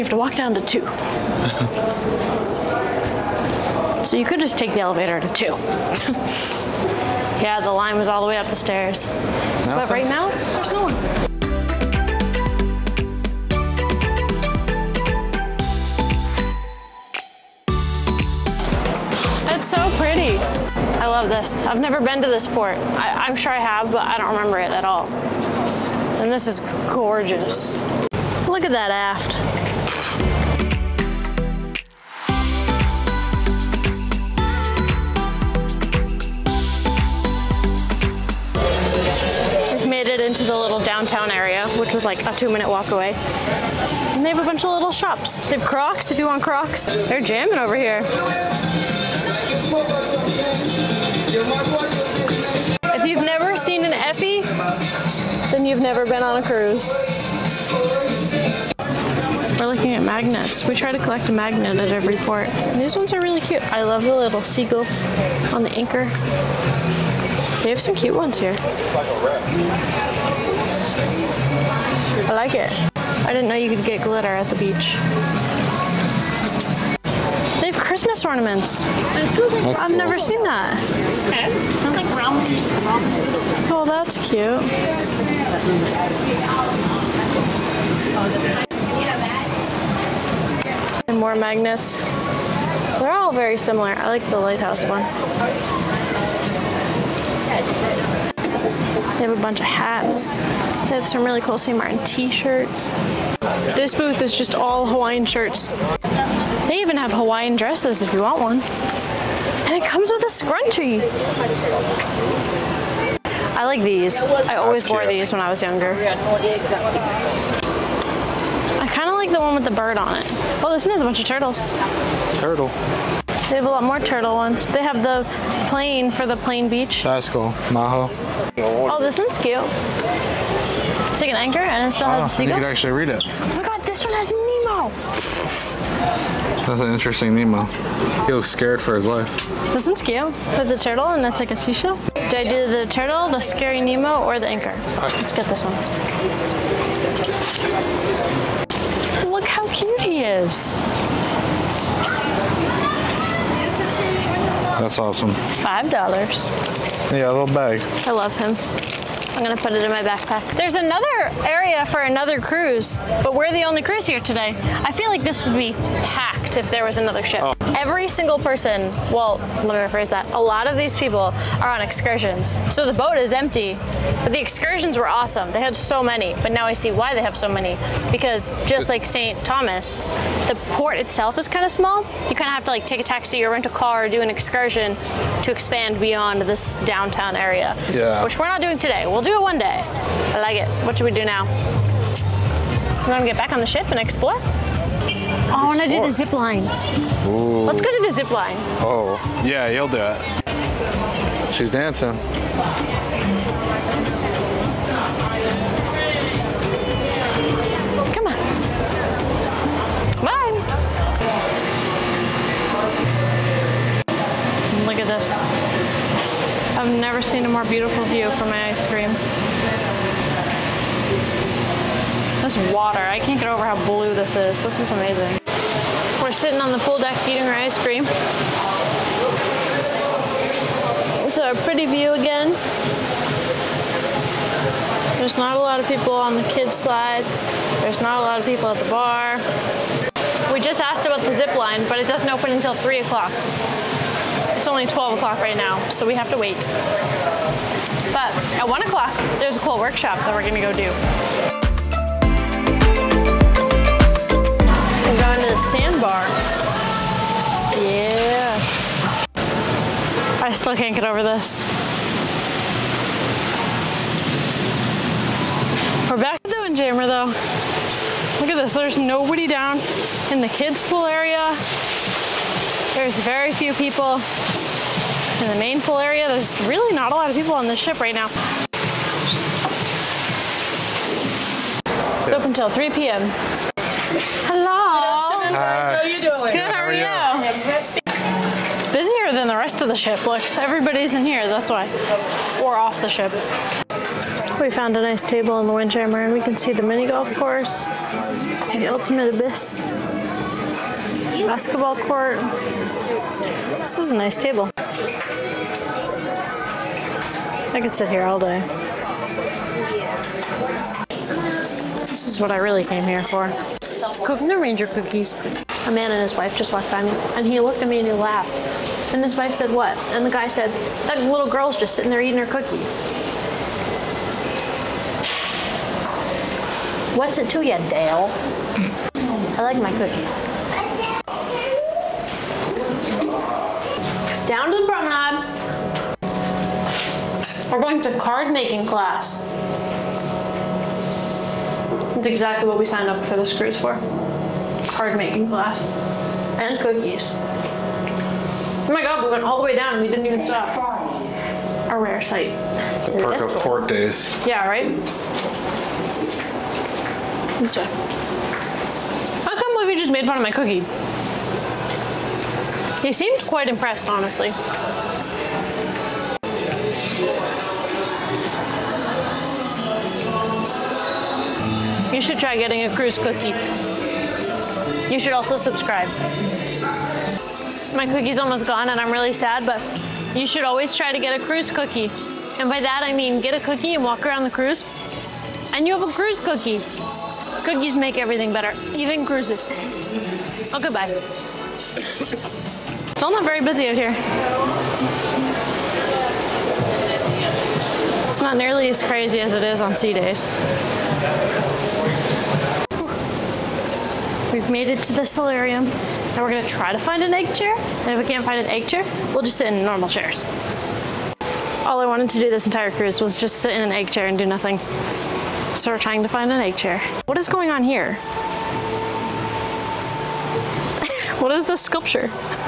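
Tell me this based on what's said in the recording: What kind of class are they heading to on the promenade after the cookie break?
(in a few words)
Card making.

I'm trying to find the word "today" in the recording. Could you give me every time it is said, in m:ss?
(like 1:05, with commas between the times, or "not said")
2:44, 3:08.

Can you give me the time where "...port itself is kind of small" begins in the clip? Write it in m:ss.
3:00.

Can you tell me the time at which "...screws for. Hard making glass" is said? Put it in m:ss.
5:43.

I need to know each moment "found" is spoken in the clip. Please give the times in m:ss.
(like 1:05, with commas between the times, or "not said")
4:54.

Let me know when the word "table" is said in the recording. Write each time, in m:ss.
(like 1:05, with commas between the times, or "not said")
4:55, 5:04.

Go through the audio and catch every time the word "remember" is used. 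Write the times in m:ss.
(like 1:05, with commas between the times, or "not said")
0:24.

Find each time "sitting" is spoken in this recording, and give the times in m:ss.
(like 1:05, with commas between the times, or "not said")
3:46, 5:21.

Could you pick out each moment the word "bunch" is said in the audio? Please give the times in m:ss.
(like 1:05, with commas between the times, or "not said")
0:44, 1:39, 2:01.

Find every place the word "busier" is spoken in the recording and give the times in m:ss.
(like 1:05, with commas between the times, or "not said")
4:48.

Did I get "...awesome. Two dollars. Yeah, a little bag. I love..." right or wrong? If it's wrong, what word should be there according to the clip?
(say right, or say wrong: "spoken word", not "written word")
wrong: "Five", not "Two".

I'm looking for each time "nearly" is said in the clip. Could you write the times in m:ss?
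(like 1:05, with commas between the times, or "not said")
6:38.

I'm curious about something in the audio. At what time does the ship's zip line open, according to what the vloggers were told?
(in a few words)
3 o'clock.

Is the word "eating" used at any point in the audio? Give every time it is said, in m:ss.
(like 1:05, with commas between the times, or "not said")
3:47, 5:22.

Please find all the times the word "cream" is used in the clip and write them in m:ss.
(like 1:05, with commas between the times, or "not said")
3:38, 3:47.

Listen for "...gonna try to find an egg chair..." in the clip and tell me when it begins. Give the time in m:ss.
6:46.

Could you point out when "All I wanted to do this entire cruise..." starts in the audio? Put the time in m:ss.
6:51.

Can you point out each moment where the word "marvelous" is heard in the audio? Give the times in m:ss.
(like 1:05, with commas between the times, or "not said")
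not said.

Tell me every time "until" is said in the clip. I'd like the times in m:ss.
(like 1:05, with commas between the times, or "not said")
4:02, 4:42.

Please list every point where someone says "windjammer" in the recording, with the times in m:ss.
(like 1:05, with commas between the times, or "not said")
4:26, 4:55.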